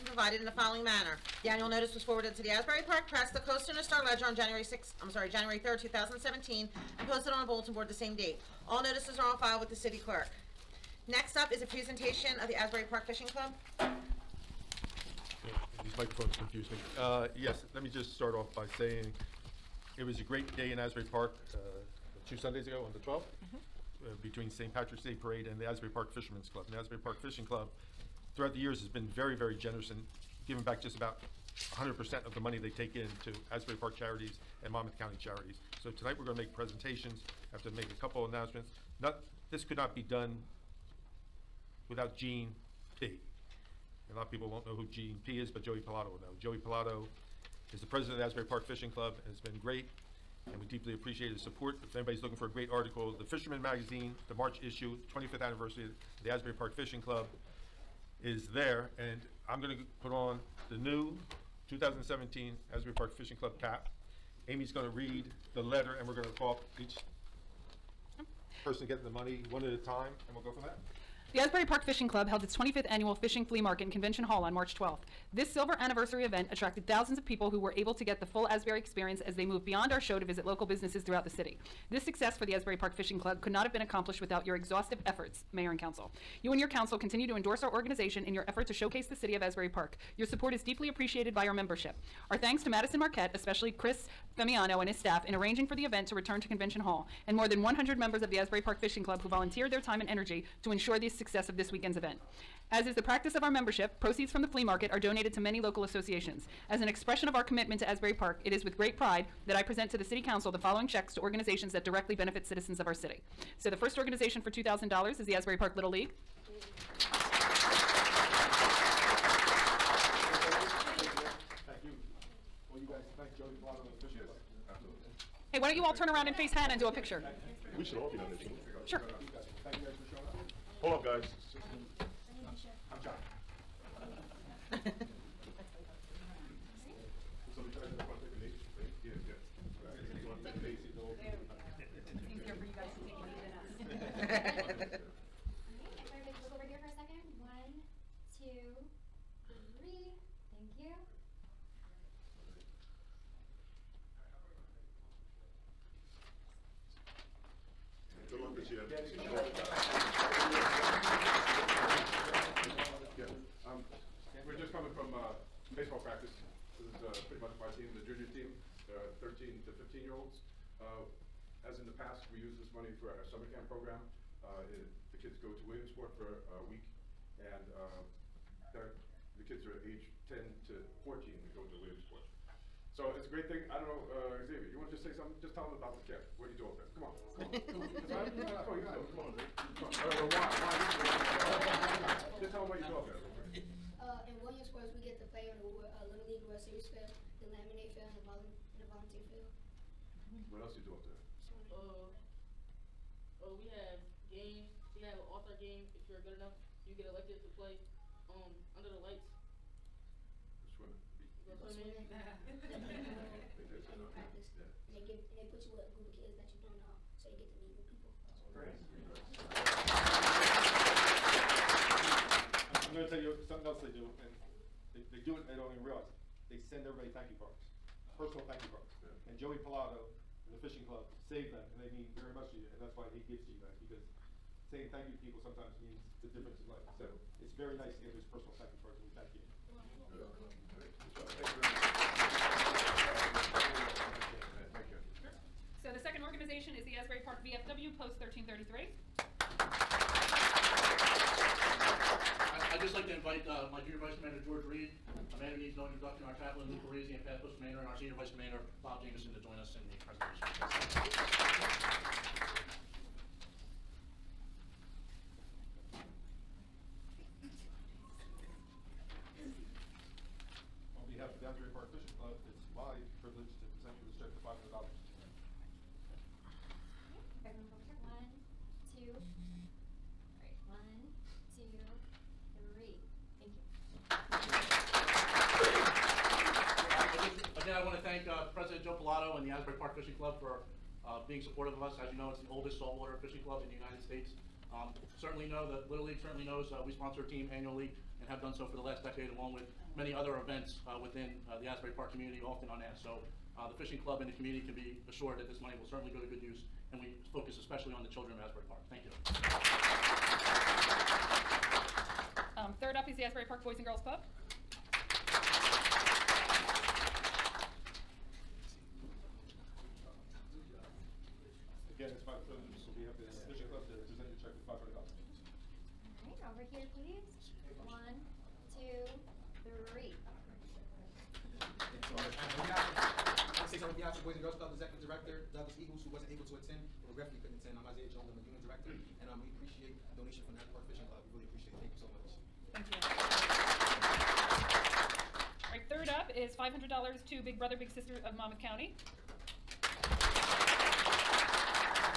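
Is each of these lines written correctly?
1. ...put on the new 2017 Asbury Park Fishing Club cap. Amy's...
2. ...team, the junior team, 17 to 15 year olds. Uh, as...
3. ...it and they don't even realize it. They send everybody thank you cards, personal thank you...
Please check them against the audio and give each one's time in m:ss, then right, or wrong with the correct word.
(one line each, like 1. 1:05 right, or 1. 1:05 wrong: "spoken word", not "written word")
1. 1:00 right
2. 2:47 wrong: "13", not "17"
3. 3:45 right.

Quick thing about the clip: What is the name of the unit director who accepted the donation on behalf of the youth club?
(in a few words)
Isaiah Jones.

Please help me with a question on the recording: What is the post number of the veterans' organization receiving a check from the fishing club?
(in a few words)
1333.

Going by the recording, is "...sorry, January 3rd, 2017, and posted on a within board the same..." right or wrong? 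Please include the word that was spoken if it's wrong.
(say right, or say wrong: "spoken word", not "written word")
wrong: "bulletin", not "within".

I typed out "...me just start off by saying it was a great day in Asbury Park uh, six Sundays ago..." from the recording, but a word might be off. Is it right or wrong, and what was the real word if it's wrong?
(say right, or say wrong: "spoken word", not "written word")
wrong: "two", not "six".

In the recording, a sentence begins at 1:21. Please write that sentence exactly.
This success for the Asbury Park Fishing Club could not have been accomplished without your exhaustive efforts, Mayor and Council.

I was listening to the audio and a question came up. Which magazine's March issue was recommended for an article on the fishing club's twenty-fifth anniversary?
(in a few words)
The Fisherman.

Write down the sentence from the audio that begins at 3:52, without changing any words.
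And that's why he gives to you guys because saying thank you to people sometimes means the difference in life.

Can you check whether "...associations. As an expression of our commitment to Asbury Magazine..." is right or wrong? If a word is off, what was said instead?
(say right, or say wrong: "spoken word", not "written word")
wrong: "Park", not "Magazine".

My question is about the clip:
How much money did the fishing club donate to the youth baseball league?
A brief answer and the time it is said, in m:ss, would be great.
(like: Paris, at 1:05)
$2,000, at 1:54.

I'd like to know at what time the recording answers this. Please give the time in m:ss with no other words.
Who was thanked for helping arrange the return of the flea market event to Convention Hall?
1:33.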